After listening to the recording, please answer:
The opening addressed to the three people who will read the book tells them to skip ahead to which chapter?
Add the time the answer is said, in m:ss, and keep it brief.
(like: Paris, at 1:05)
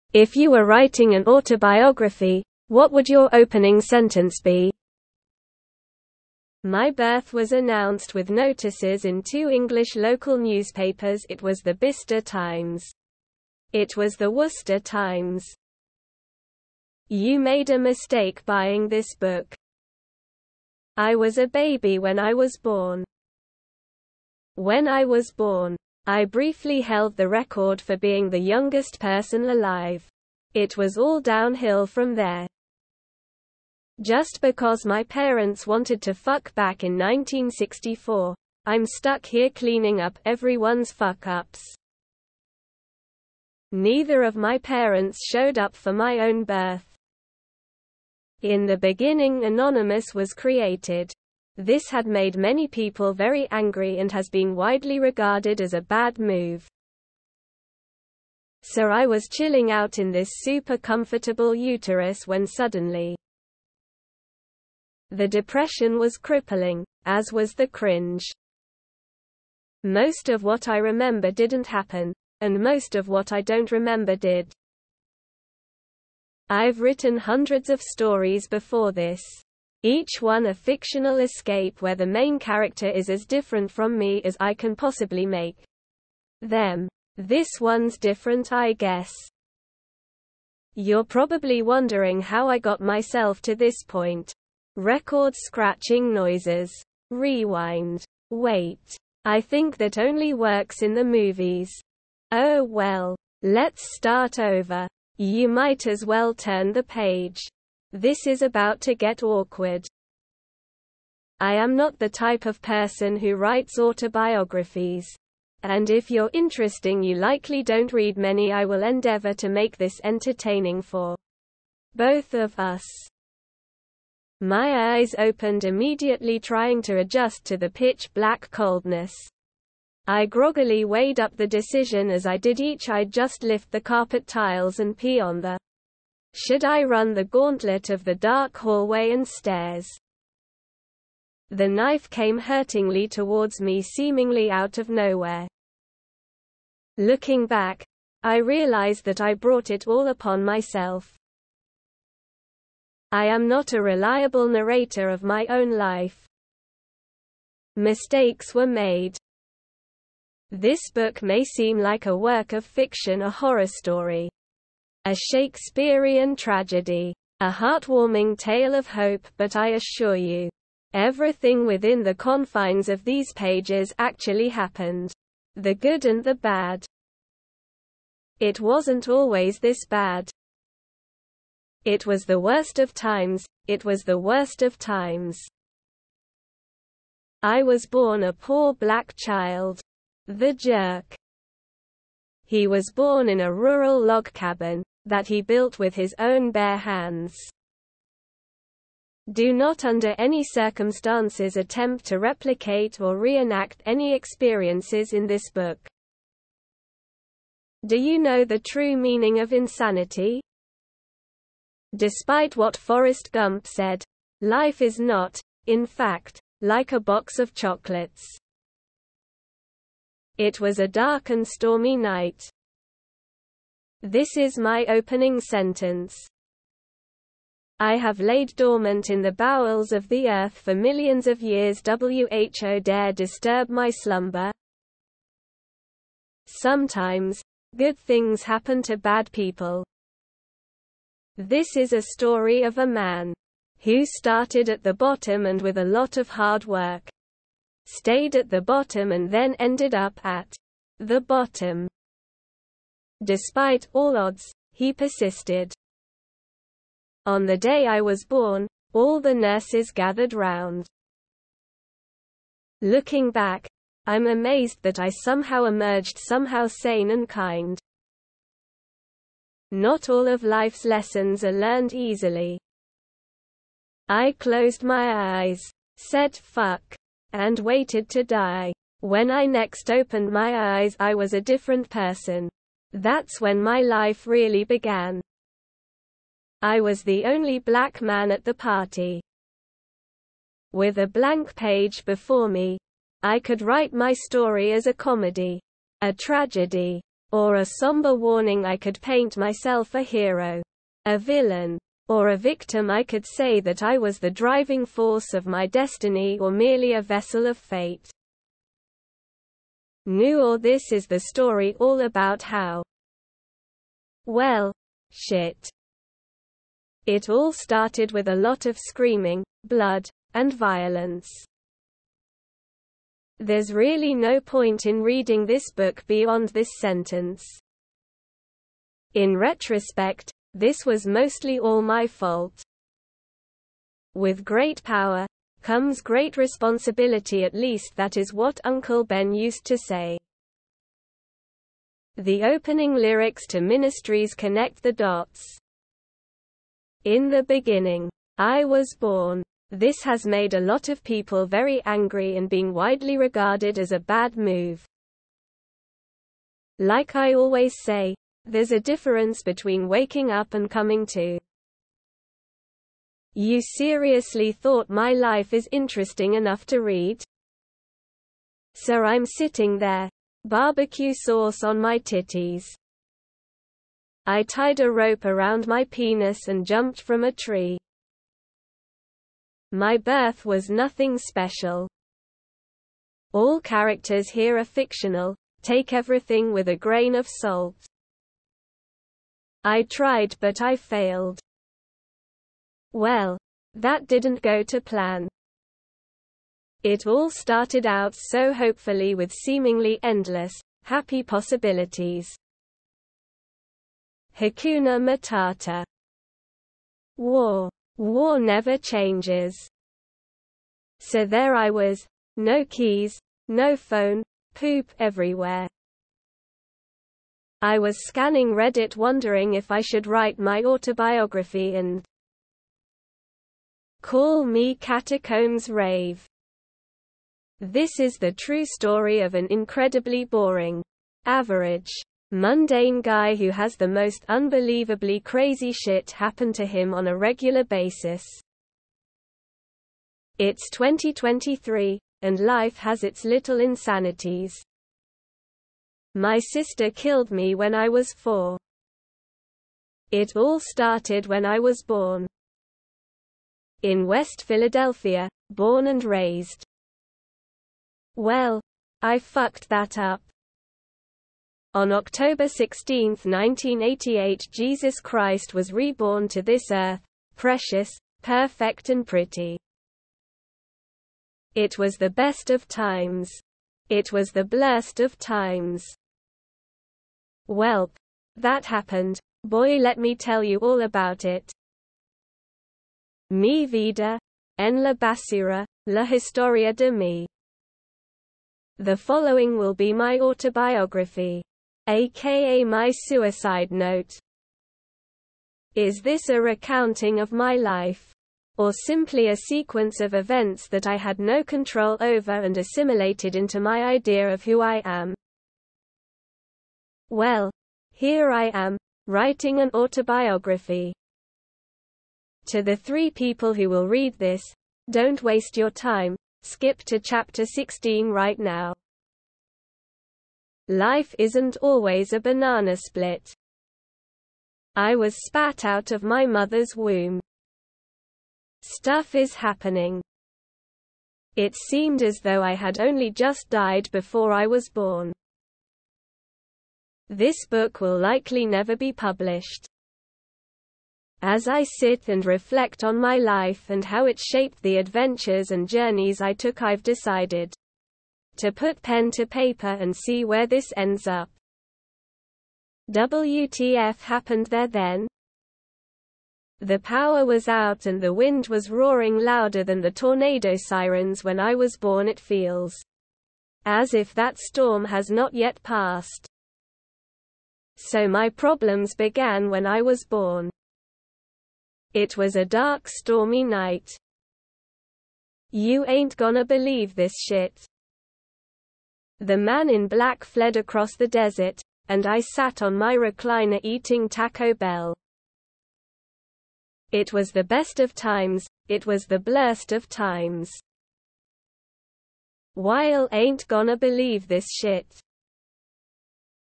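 Chapter 16, at 8:36.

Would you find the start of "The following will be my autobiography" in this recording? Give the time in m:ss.
8:08.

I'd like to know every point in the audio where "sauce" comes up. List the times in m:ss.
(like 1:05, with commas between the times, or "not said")
6:11.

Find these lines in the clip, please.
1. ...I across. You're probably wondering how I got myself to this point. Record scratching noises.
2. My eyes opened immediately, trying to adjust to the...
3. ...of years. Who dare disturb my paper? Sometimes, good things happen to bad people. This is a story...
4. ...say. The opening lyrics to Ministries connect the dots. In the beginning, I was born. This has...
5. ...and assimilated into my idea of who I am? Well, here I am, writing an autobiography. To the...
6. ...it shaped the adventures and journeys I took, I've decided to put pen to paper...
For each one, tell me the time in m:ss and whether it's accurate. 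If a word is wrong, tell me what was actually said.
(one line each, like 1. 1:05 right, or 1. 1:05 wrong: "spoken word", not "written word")
1. 1:28 wrong: "guess", not "across"
2. 2:04 right
3. 3:51 wrong: "slumber", not "paper"
4. 5:39 right
5. 8:22 right
6. 9:04 right.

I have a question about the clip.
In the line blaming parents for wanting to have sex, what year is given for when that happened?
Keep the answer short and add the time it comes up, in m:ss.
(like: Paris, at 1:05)
1964, at 0:36.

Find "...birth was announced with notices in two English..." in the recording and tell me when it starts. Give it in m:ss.
0:06.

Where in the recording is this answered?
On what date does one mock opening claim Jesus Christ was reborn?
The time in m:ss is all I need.
7:41.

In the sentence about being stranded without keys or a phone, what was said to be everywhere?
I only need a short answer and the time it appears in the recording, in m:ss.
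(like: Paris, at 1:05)
poop, at 6:54.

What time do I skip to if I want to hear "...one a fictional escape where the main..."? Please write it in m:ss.
1:20.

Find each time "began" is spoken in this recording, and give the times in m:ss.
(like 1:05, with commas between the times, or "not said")
4:44, 9:28.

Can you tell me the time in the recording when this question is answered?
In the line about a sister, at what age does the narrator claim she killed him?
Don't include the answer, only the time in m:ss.
7:28.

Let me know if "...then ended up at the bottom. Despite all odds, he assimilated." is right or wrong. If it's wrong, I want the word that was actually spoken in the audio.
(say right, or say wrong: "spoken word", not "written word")
wrong: "persisted", not "assimilated".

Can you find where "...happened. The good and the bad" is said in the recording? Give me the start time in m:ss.
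2:54.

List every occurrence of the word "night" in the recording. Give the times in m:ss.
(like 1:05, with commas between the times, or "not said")
3:41, 9:33.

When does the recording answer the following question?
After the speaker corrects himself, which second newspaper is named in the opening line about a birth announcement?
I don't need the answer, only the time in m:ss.
0:14.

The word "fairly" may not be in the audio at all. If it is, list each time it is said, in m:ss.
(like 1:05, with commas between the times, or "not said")
not said.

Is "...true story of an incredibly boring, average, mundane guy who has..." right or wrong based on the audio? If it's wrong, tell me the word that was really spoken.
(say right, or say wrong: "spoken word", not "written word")
right.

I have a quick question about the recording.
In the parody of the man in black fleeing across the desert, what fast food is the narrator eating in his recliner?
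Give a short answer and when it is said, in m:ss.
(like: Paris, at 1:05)
Taco Bell, at 9:44.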